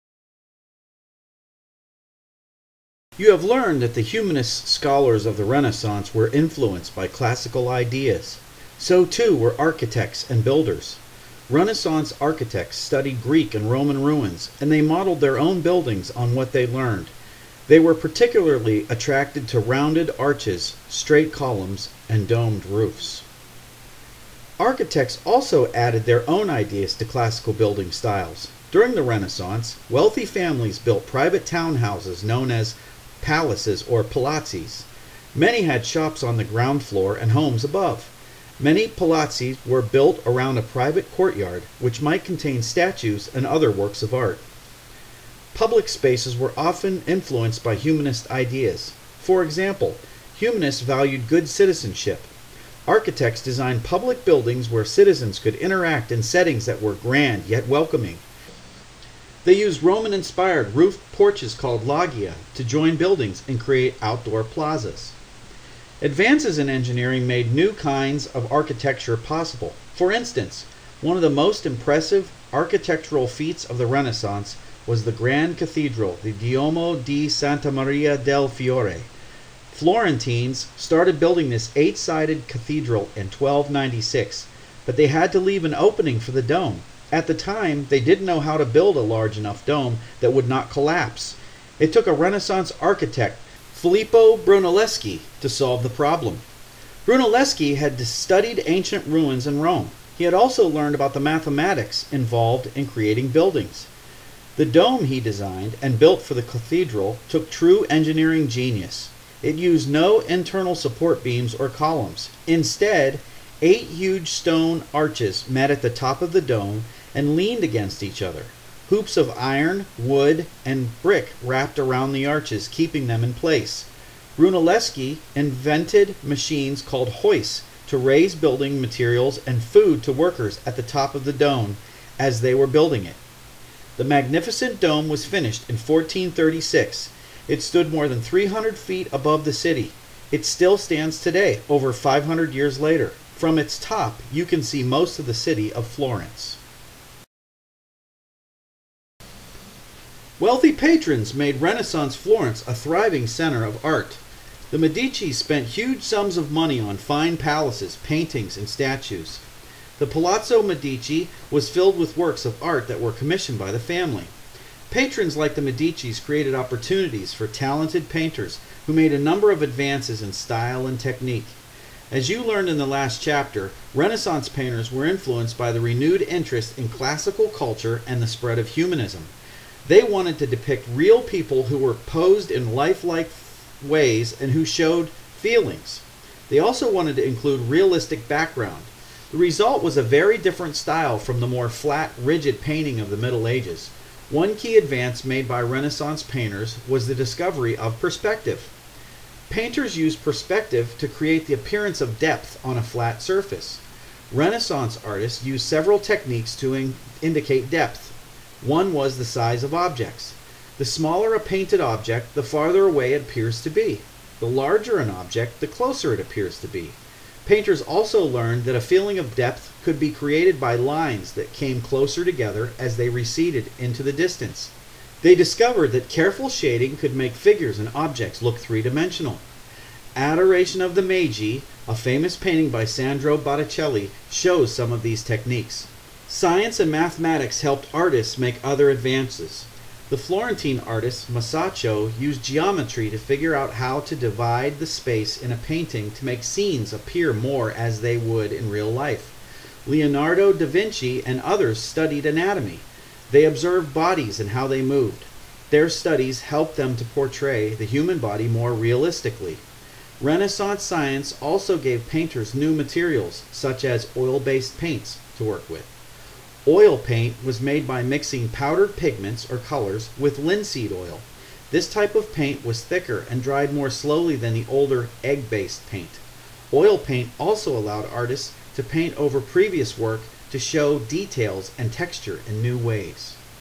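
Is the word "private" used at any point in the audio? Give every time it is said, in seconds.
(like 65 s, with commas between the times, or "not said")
31 s, 40 s.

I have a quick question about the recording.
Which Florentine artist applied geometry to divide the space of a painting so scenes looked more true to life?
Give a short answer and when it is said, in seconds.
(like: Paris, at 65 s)
Masaccio, at 241 s.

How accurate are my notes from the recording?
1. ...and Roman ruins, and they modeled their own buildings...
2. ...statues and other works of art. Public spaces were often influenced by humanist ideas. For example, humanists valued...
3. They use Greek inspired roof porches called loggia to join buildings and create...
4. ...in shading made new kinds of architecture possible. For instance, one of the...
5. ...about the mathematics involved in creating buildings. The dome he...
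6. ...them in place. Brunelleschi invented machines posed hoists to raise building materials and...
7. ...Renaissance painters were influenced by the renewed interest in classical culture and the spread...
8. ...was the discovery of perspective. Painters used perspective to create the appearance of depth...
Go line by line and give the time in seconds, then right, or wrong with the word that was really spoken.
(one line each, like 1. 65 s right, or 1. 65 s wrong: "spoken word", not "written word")
1. 13 s right
2. 42 s right
3. 59 s wrong: "Roman", not "Greek"
4. 66 s wrong: "engineering", not "shading"
5. 100 s right
6. 123 s wrong: "called", not "posed"
7. 173 s right
8. 196 s right.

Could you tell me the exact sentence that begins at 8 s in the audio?
So too were architects and builders.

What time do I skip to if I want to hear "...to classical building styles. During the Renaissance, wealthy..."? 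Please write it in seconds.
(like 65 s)
26 s.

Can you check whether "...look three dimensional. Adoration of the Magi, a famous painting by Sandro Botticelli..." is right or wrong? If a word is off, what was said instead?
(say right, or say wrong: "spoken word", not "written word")
right.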